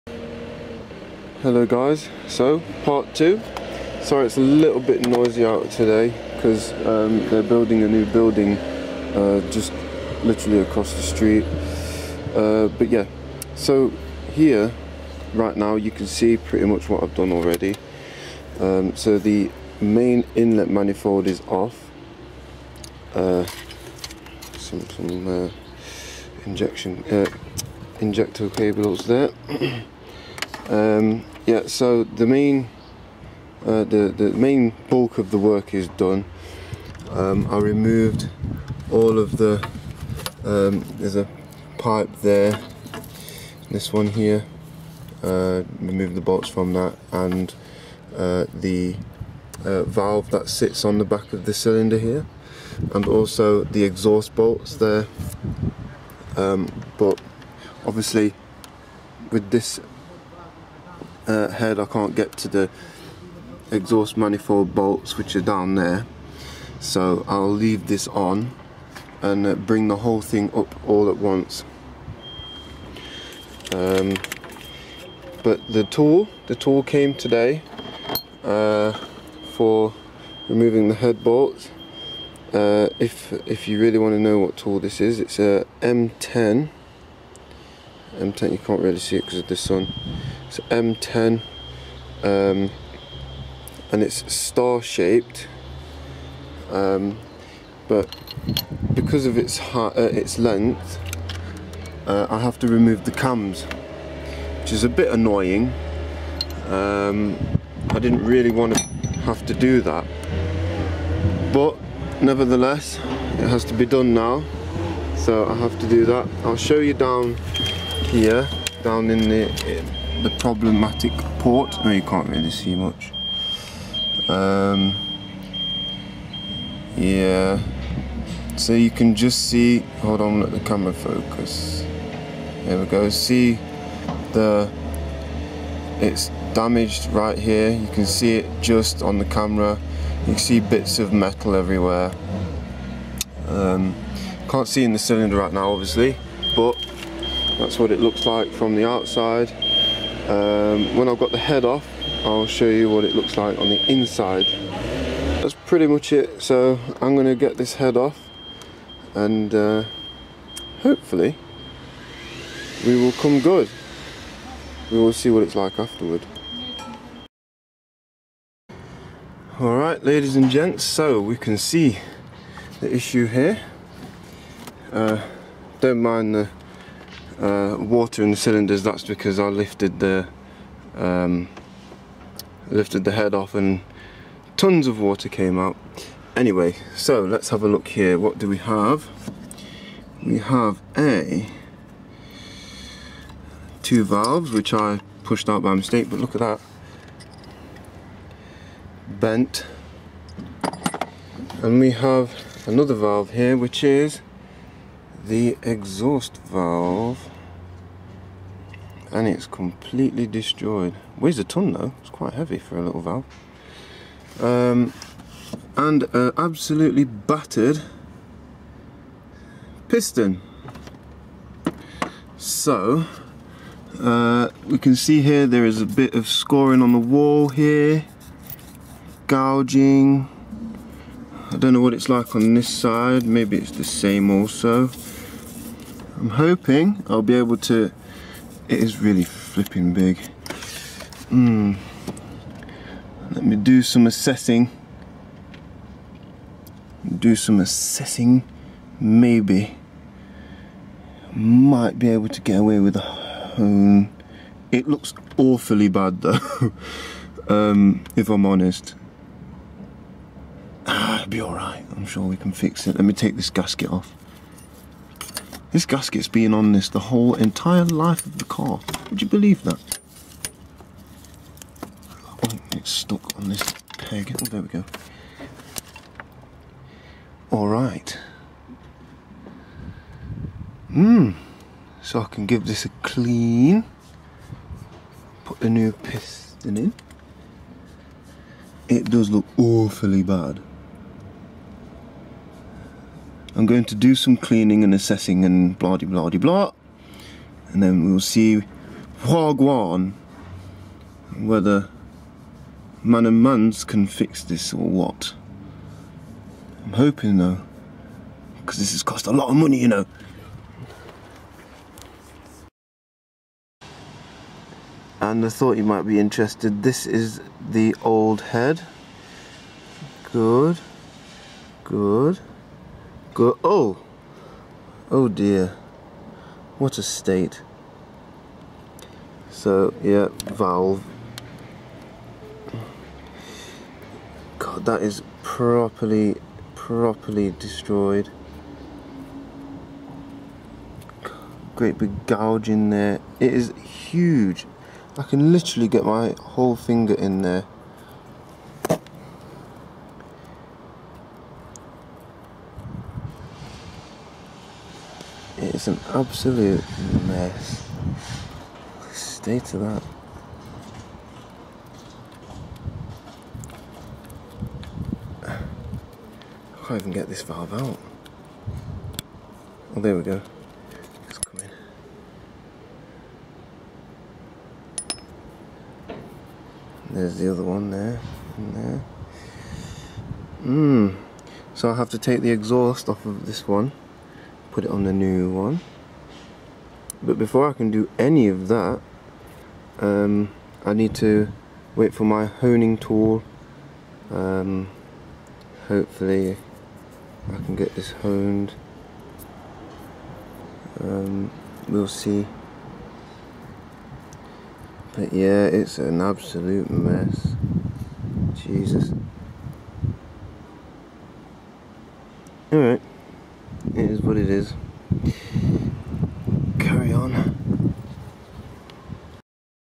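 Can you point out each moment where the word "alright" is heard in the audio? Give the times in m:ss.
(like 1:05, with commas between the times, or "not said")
2:49, 4:21, 4:37, 6:52.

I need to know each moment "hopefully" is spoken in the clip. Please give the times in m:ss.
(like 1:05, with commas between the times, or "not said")
2:40, 6:35.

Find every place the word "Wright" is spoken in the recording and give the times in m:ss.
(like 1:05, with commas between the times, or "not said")
not said.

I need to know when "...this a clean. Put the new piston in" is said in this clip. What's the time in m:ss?
4:42.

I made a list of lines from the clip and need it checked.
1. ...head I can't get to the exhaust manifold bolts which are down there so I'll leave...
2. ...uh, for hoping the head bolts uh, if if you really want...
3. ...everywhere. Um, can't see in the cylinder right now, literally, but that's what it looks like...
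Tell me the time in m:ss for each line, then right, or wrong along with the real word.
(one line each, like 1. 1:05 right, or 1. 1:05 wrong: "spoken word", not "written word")
1. 1:01 right
2. 1:18 wrong: "removing", not "hoping"
3. 2:21 wrong: "obviously", not "literally".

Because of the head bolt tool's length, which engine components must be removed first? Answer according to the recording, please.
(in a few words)
The cams.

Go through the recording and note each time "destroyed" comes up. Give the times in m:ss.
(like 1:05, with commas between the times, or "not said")
3:30, 5:37.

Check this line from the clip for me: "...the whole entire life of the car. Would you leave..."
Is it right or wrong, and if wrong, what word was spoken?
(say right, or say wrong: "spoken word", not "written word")
wrong: "believe", not "leave".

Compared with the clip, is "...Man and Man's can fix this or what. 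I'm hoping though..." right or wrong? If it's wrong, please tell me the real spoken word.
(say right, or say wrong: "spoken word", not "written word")
right.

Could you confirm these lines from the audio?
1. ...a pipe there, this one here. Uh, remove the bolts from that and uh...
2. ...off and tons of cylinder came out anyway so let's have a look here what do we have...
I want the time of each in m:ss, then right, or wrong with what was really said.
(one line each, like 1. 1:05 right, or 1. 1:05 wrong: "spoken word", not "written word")
1. 0:41 right
2. 3:03 wrong: "water", not "cylinder".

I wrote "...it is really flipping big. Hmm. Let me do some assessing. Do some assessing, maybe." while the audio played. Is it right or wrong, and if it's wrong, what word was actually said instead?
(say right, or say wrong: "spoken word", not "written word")
right.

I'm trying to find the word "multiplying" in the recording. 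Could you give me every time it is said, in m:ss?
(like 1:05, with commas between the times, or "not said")
not said.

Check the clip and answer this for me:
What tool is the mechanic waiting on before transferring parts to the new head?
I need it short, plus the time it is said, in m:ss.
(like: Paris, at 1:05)
Honing tool, at 6:32.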